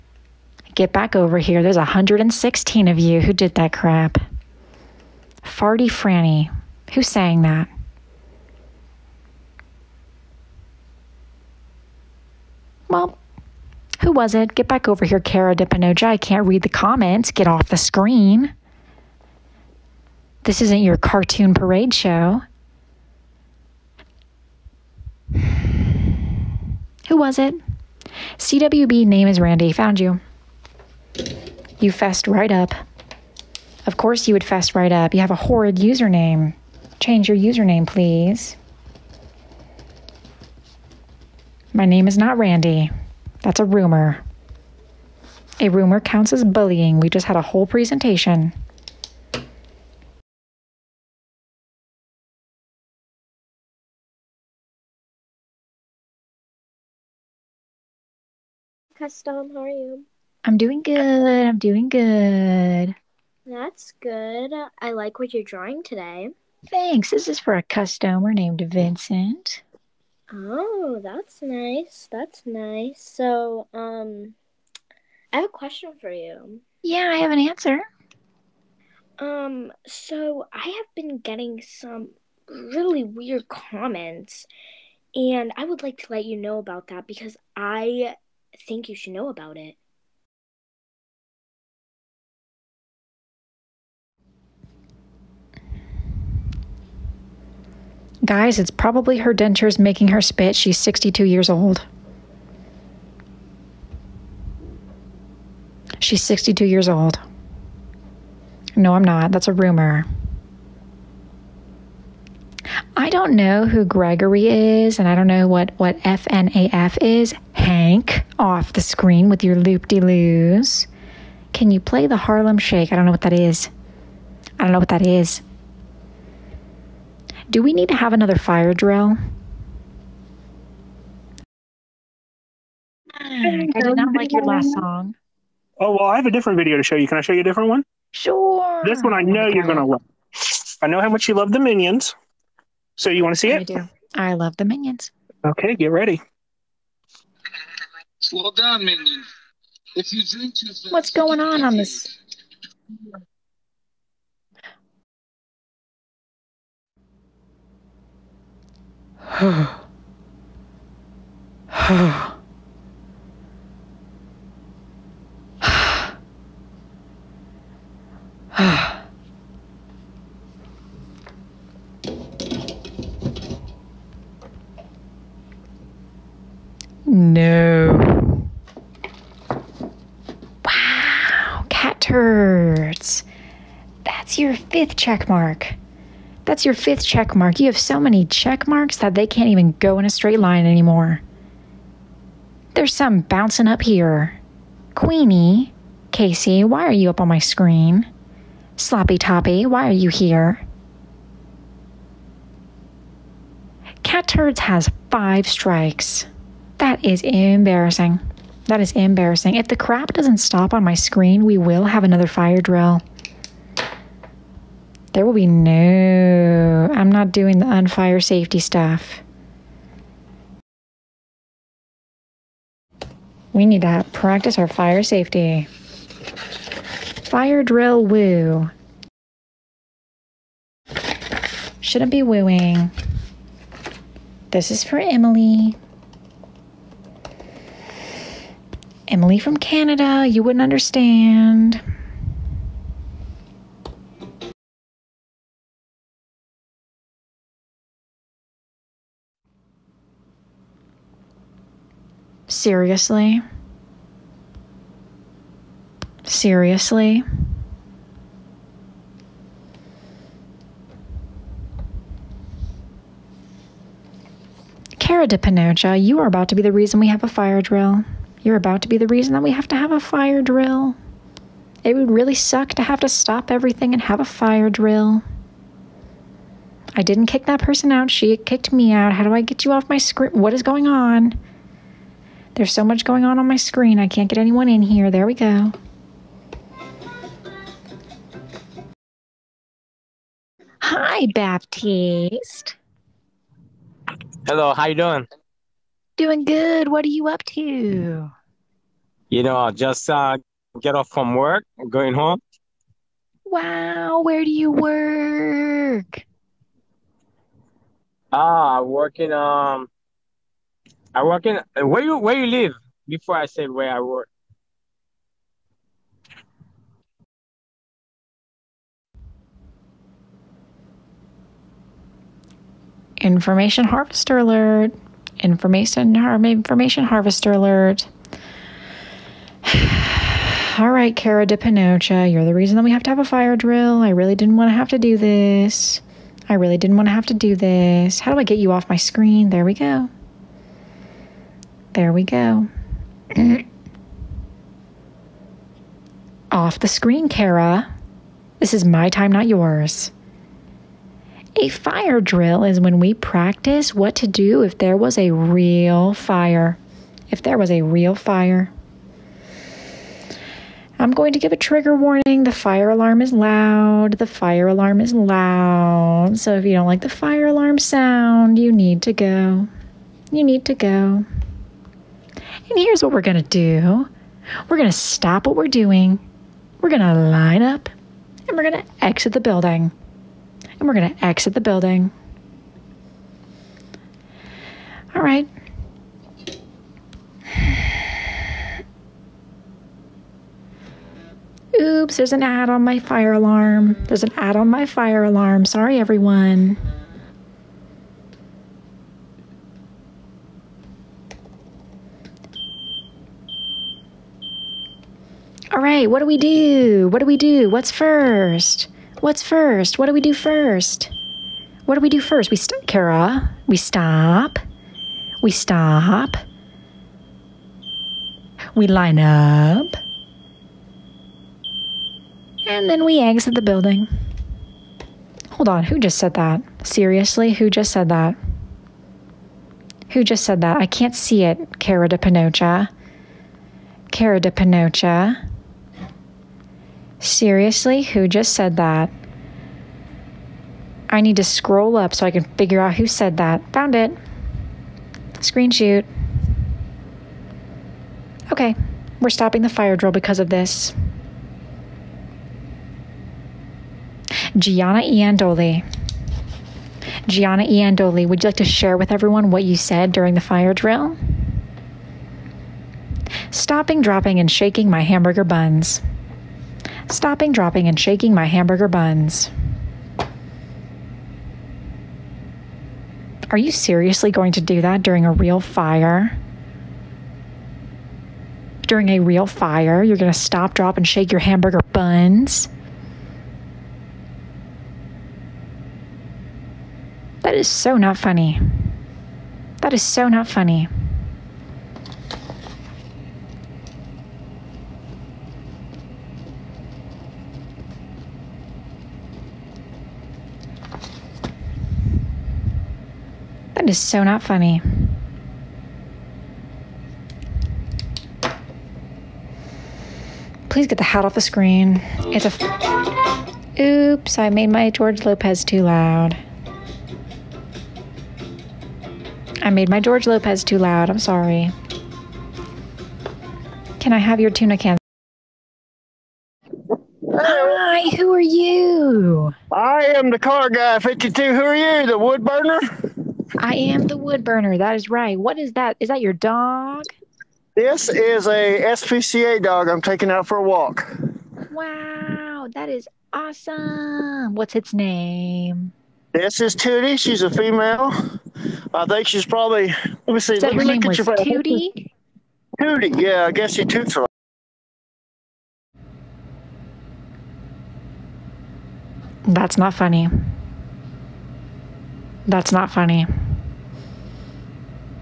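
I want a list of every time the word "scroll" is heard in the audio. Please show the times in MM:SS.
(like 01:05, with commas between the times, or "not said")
07:21.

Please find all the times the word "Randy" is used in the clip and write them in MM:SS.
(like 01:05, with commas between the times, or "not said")
00:29, 00:42.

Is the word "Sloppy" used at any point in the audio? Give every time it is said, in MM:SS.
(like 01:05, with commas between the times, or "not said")
03:18.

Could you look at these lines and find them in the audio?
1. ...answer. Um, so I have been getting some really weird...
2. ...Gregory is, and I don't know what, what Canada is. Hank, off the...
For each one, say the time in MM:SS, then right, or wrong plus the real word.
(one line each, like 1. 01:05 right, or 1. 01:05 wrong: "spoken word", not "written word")
1. 01:17 right
2. 01:53 wrong: "FNAF", not "Canada".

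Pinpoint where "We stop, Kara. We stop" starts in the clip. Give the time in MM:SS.
06:52.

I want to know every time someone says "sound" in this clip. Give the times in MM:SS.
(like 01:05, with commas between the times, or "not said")
06:07.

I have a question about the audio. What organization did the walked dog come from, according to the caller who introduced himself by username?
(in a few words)
SPCA.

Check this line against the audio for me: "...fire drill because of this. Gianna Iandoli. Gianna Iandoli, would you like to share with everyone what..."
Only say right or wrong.
right.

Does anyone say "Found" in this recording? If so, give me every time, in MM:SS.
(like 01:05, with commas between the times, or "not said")
00:29, 07:23.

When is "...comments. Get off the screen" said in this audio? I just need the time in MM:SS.
00:16.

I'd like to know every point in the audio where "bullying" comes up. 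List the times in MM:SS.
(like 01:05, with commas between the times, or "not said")
00:46.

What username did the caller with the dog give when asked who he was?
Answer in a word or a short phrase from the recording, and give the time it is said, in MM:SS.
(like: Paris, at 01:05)
the car guy 52, at 08:50.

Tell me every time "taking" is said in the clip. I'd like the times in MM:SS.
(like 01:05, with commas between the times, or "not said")
09:00.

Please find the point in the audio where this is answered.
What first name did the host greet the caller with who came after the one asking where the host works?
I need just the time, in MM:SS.
04:51.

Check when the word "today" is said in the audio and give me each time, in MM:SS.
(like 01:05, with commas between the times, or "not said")
01:05.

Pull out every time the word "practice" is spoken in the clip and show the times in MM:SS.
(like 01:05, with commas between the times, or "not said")
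03:44, 05:53.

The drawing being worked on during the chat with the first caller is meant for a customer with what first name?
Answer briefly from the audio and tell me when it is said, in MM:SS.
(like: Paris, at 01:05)
Vincent, at 01:08.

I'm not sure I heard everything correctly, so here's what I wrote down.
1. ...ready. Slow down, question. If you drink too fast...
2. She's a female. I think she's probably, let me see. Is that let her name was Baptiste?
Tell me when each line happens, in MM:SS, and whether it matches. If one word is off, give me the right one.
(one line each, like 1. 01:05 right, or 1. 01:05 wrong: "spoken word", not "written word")
1. 02:25 wrong: "minion", not "question"
2. 09:07 wrong: "Tootie", not "Baptiste".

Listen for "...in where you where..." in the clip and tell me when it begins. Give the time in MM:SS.
05:11.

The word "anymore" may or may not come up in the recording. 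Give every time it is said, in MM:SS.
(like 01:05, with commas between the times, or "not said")
03:10.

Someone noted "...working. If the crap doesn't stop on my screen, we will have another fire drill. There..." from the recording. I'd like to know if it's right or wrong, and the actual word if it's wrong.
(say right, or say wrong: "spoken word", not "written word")
wrong: "embarrassing", not "working".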